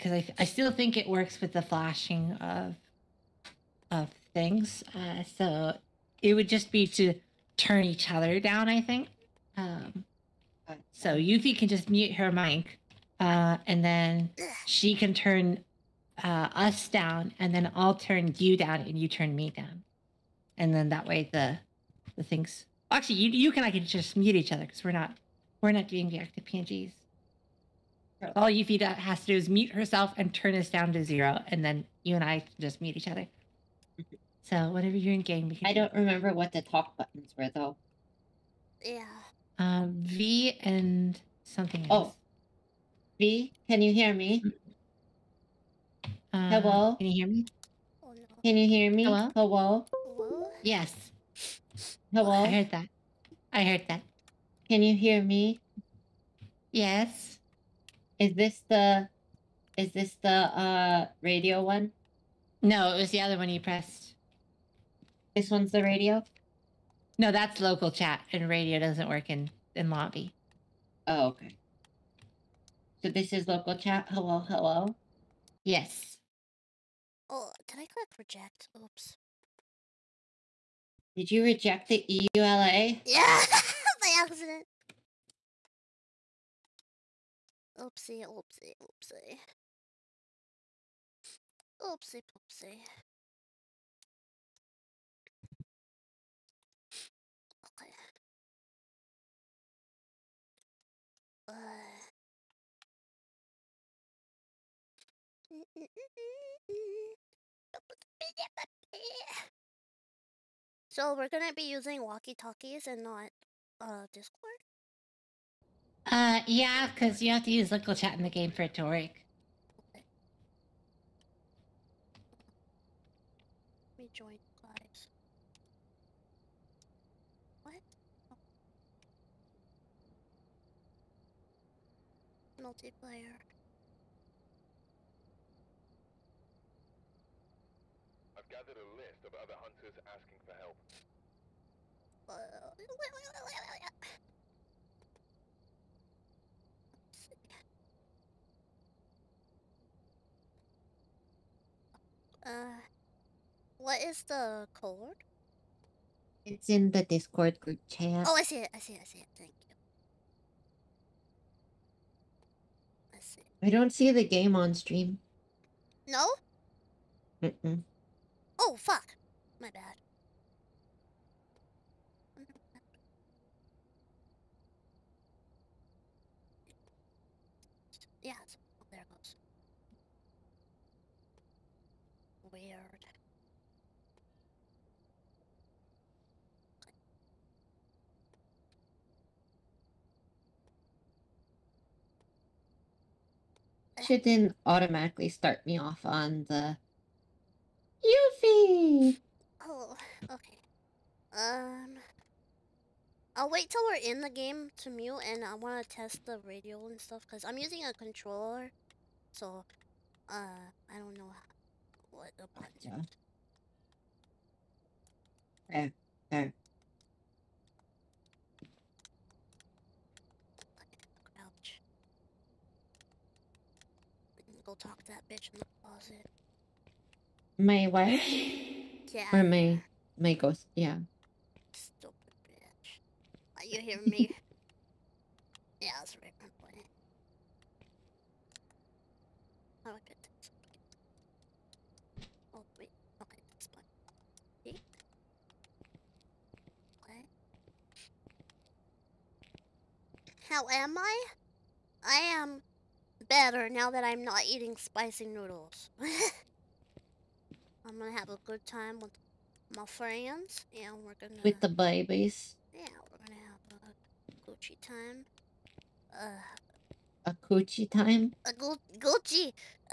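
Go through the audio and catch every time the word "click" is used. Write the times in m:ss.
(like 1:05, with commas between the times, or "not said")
1:17.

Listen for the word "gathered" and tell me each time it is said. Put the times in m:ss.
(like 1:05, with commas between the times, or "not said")
2:18.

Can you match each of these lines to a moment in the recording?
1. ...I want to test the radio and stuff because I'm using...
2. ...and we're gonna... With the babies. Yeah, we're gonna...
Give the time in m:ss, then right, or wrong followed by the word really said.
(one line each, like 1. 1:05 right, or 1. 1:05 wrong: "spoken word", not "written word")
1. 3:25 right
2. 4:20 right.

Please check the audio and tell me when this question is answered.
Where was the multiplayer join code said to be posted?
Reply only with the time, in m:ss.
2:37.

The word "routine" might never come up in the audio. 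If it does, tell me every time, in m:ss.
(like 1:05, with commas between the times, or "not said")
not said.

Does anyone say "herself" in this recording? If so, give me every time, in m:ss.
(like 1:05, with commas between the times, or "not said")
0:29.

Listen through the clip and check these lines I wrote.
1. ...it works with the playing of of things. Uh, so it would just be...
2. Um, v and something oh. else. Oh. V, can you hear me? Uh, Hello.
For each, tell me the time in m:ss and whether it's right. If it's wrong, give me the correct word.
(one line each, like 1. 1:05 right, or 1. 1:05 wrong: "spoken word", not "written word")
1. 0:00 wrong: "flashing", not "playing"
2. 0:39 right.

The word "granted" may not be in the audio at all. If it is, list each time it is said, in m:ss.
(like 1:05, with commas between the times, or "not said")
not said.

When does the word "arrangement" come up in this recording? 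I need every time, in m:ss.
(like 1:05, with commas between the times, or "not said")
not said.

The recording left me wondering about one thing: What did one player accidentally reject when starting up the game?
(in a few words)
The EULA.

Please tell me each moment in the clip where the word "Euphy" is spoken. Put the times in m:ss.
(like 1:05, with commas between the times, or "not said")
0:11, 3:18.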